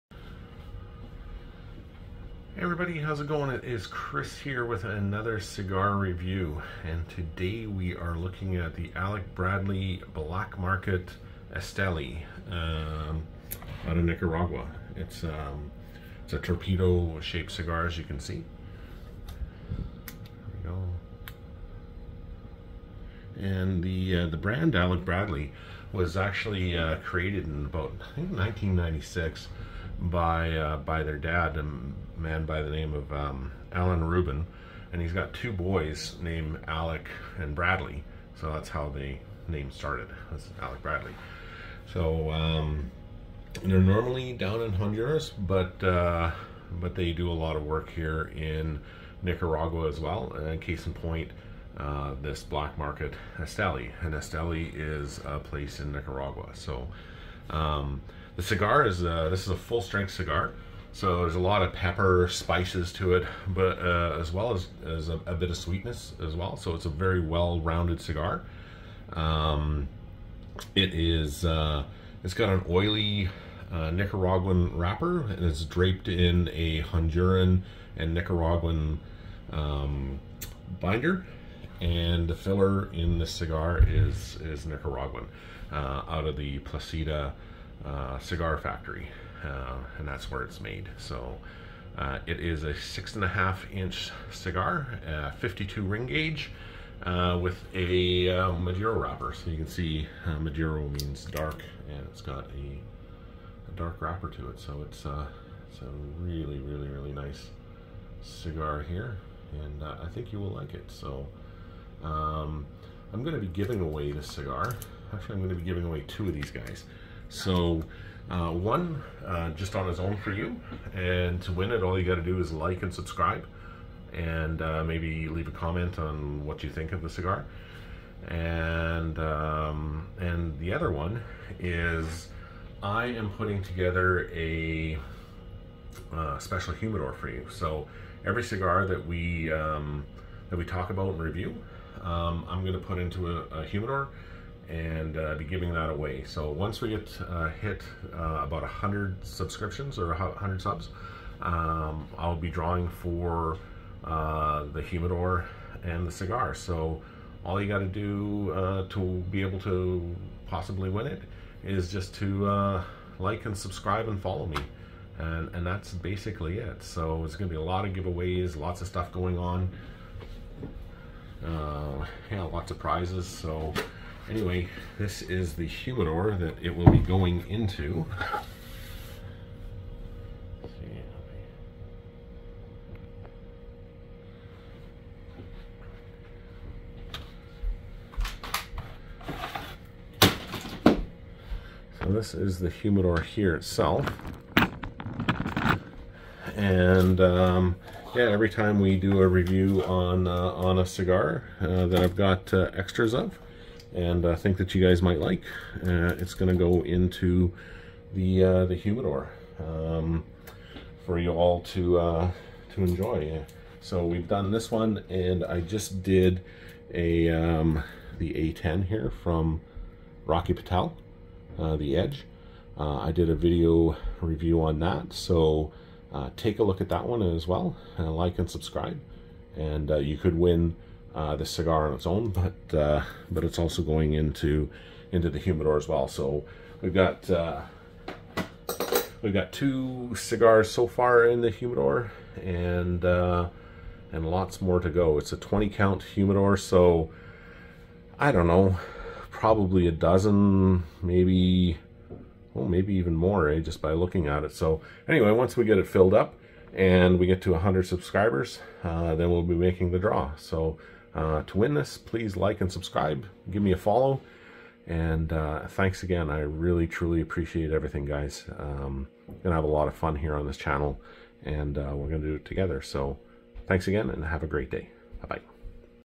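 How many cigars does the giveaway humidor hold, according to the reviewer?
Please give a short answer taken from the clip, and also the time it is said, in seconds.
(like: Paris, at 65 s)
20, at 245 s.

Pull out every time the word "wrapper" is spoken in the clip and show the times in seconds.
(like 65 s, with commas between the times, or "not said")
74 s, 98 s, 104 s.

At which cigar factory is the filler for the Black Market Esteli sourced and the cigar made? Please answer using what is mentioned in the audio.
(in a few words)
Plasencia.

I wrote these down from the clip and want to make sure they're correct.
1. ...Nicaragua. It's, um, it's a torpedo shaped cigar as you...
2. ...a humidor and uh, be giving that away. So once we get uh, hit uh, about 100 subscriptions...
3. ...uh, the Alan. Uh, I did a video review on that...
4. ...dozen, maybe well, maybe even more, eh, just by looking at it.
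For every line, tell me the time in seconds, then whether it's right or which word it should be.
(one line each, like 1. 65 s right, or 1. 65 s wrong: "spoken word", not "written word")
1. 14 s right
2. 143 s right
3. 221 s wrong: "Edge", not "Alan"
4. 249 s right.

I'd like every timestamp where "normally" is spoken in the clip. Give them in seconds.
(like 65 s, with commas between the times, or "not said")
43 s.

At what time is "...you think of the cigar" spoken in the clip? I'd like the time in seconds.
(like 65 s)
126 s.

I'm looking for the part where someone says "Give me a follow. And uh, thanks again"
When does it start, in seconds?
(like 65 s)
263 s.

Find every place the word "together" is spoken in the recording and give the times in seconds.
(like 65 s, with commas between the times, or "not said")
133 s, 272 s.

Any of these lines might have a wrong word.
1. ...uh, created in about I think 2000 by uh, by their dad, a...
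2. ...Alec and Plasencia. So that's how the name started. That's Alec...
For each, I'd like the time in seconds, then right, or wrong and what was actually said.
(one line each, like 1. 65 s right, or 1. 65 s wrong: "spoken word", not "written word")
1. 26 s wrong: "1996", not "2000"
2. 36 s wrong: "Bradley", not "Plasencia".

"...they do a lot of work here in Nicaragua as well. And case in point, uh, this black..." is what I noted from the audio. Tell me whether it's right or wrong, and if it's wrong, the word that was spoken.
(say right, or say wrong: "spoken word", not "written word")
right.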